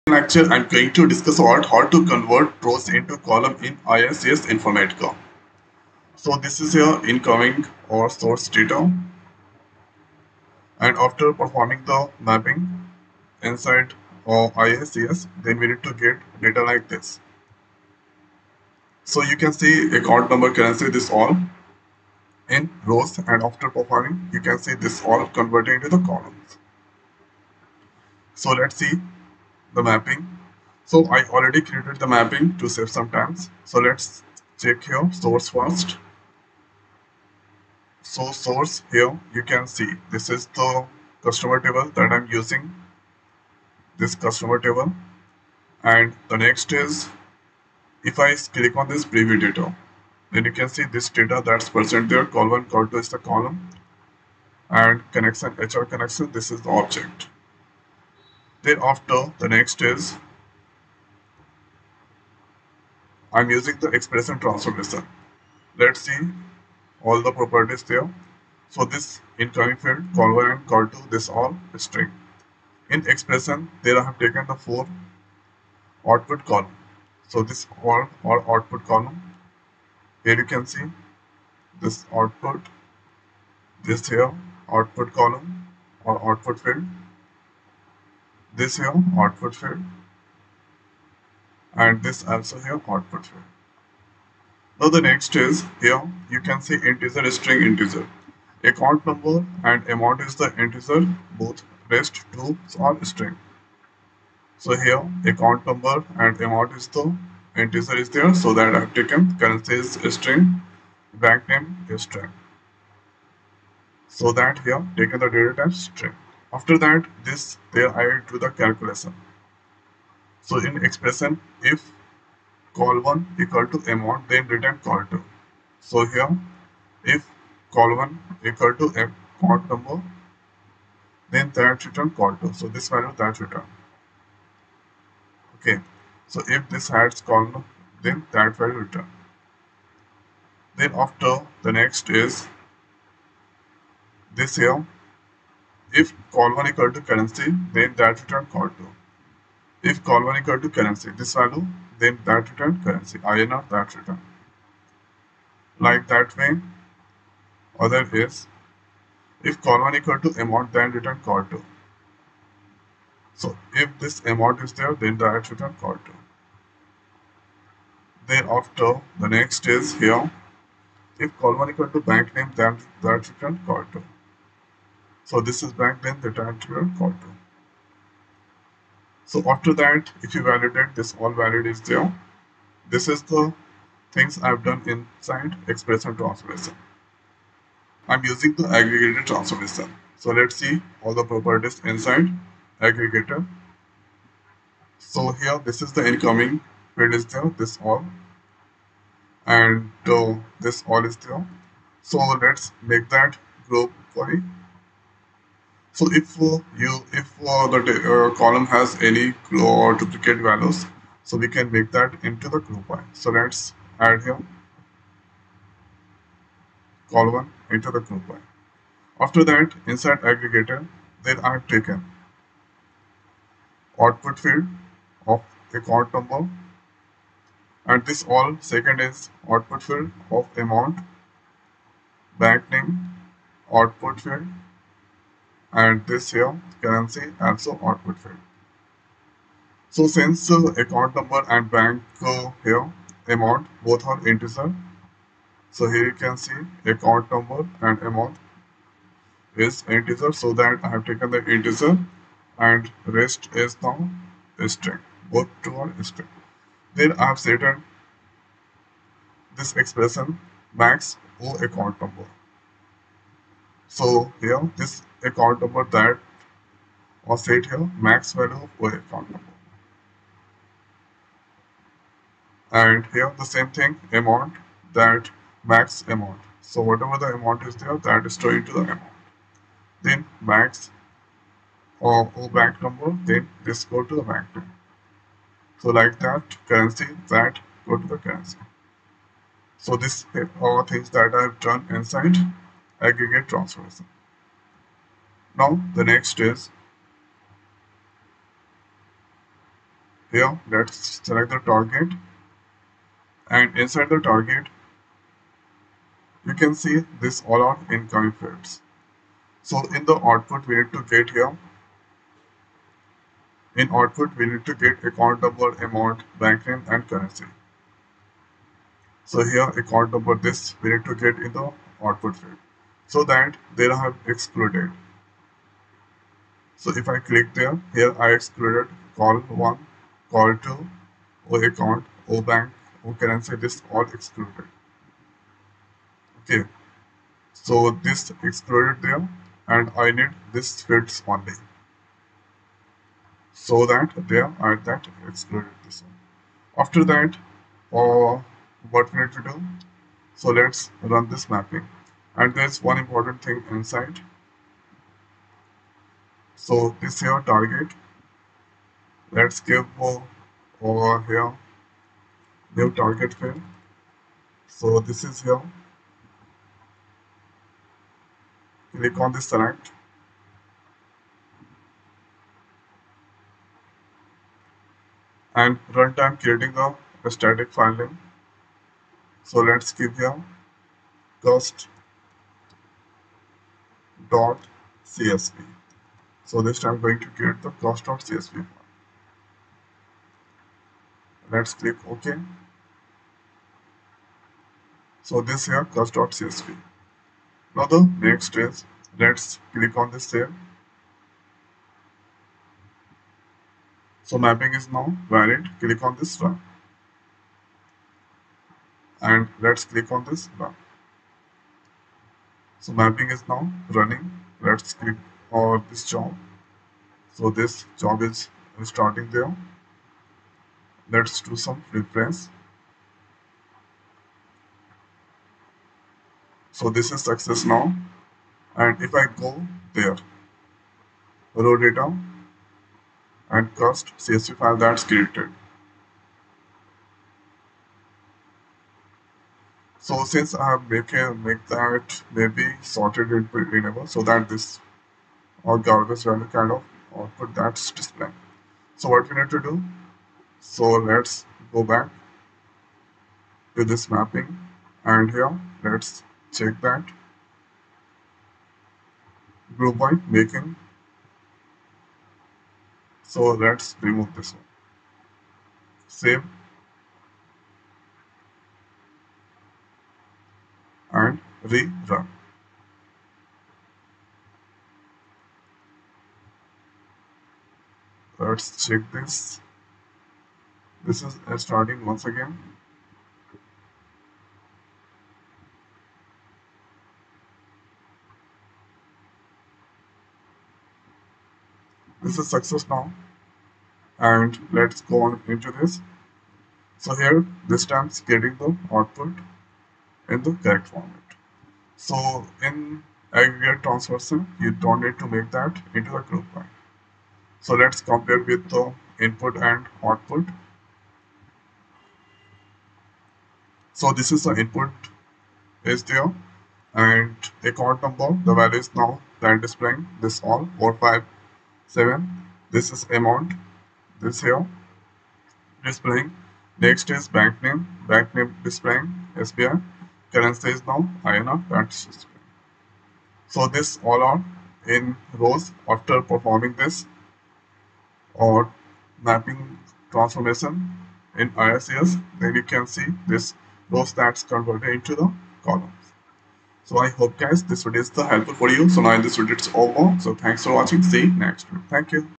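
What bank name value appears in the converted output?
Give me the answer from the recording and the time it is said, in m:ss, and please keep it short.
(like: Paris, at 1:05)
SBI, at 8:49.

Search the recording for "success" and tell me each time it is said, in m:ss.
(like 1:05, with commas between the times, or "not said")
7:07, 8:12.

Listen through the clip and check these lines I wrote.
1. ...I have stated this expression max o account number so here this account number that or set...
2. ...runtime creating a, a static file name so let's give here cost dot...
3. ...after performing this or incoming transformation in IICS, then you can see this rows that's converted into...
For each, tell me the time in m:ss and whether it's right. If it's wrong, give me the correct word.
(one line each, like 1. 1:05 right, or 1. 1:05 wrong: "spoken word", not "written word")
1. 4:17 right
2. 6:15 right
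3. 8:55 wrong: "mapping", not "incoming".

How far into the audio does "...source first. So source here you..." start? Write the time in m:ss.
0:35.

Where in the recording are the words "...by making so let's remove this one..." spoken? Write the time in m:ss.
7:39.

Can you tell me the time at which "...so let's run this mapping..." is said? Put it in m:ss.
5:50.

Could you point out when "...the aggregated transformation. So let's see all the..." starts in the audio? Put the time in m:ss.
3:08.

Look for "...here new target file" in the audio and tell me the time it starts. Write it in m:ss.
6:01.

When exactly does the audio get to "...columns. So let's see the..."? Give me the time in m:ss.
0:26.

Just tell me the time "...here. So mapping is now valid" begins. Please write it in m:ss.
6:40.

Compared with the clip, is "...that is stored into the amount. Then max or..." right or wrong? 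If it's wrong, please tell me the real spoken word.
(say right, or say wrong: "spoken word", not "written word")
right.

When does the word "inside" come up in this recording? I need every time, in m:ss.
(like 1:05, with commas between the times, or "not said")
0:13, 3:04, 3:11, 3:39, 4:51, 5:03, 5:53.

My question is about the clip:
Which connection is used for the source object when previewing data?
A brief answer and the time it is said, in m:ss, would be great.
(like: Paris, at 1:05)
HR connection, at 0:55.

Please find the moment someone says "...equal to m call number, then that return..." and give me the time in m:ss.
2:08.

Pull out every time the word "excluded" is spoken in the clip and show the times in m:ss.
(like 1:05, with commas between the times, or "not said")
5:24, 5:28, 5:34, 5:38, 5:45.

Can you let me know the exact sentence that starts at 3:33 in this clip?
So let's add here column into the group by.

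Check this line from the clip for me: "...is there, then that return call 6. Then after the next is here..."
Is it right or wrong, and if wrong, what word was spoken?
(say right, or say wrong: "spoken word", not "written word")
wrong: "2", not "6".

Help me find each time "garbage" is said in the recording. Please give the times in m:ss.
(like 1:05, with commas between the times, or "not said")
7:25.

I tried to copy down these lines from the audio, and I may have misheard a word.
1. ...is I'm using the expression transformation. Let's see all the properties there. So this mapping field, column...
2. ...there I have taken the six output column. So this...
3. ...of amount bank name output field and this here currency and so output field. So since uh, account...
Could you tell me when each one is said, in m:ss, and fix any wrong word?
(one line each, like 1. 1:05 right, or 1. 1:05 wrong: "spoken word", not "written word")
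1. 0:59 wrong: "incoming", not "mapping"
2. 1:13 wrong: "four", not "six"
3. 3:50 right.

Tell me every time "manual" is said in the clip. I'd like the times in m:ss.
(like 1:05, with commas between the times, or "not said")
not said.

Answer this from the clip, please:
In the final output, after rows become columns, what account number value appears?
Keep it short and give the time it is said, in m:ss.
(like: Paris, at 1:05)
457, at 8:40.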